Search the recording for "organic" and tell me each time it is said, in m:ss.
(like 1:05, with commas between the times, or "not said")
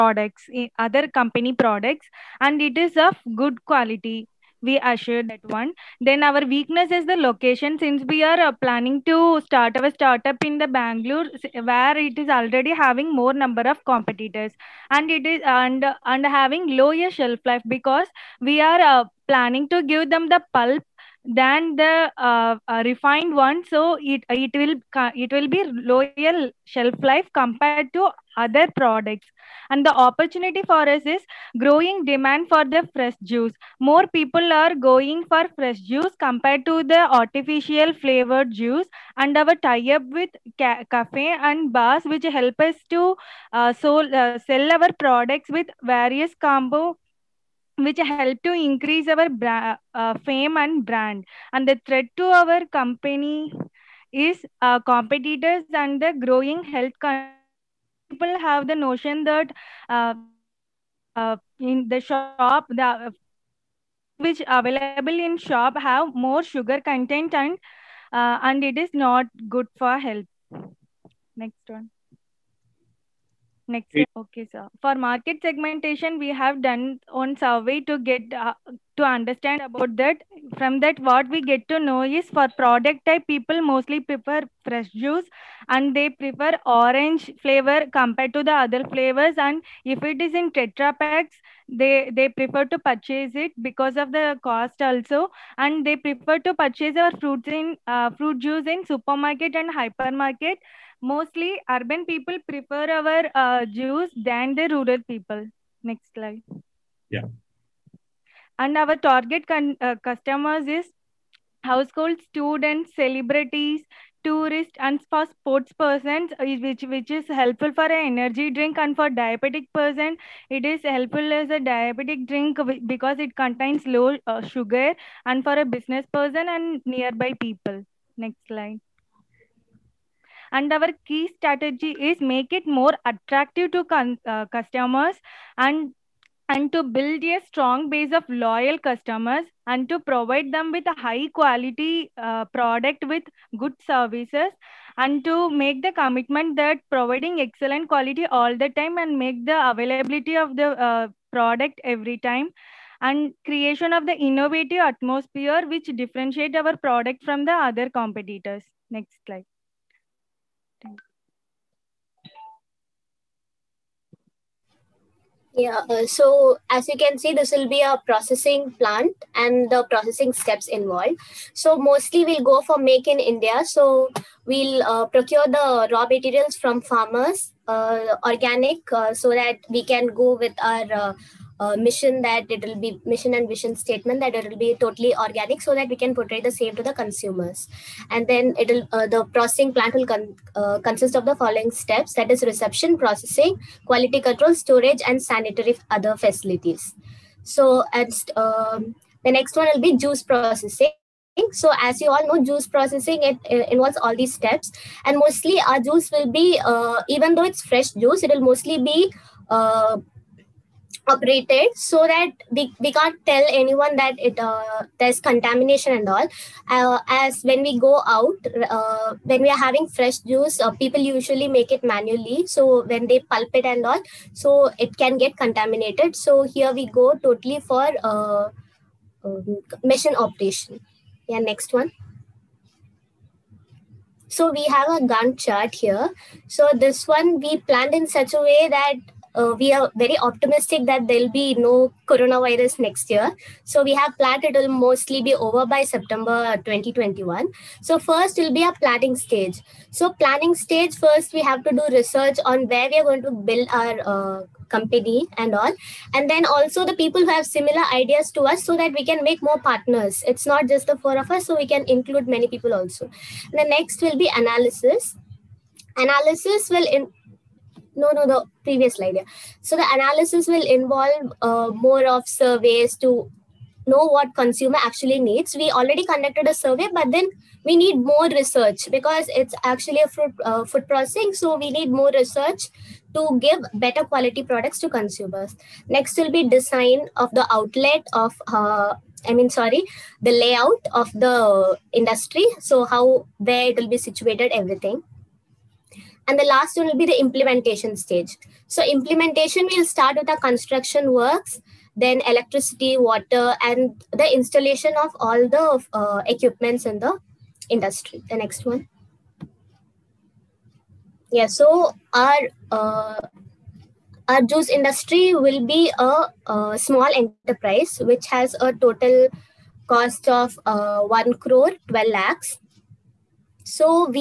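2:58, 3:05.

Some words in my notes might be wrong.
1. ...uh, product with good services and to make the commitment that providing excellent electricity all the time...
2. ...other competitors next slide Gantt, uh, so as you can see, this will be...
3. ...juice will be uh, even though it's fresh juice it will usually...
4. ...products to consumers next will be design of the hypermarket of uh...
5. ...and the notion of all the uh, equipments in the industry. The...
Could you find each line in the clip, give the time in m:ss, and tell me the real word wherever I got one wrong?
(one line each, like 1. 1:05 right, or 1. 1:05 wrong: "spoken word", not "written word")
1. 2:22 wrong: "quality", not "electricity"
2. 2:37 wrong: "Yeah", not "Gantt"
3. 3:25 wrong: "mostly", not "usually"
4. 4:44 wrong: "outlet", not "hypermarket"
5. 5:03 wrong: "installation", not "notion".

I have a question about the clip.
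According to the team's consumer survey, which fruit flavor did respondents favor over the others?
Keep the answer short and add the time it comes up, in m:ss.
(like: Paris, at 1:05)
Orange, at 1:26.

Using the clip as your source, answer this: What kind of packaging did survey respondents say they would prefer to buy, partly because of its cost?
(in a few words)
Tetra packs.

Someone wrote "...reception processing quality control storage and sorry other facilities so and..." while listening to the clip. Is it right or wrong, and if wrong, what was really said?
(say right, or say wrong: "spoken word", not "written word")
wrong: "sanitary", not "sorry".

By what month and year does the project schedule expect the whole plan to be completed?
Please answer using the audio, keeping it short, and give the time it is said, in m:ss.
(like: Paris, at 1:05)
September 2021, at 4:05.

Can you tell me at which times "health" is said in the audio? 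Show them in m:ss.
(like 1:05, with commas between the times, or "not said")
0:56, 1:09.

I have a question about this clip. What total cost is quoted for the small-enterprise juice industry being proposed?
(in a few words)
1 crore 12 lakhs.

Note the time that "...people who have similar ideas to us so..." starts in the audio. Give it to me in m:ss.
4:16.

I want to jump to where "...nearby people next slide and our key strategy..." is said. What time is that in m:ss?
2:06.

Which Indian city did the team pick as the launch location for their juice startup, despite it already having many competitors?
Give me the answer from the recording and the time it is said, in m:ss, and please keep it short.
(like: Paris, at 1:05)
Bangalore, at 0:10.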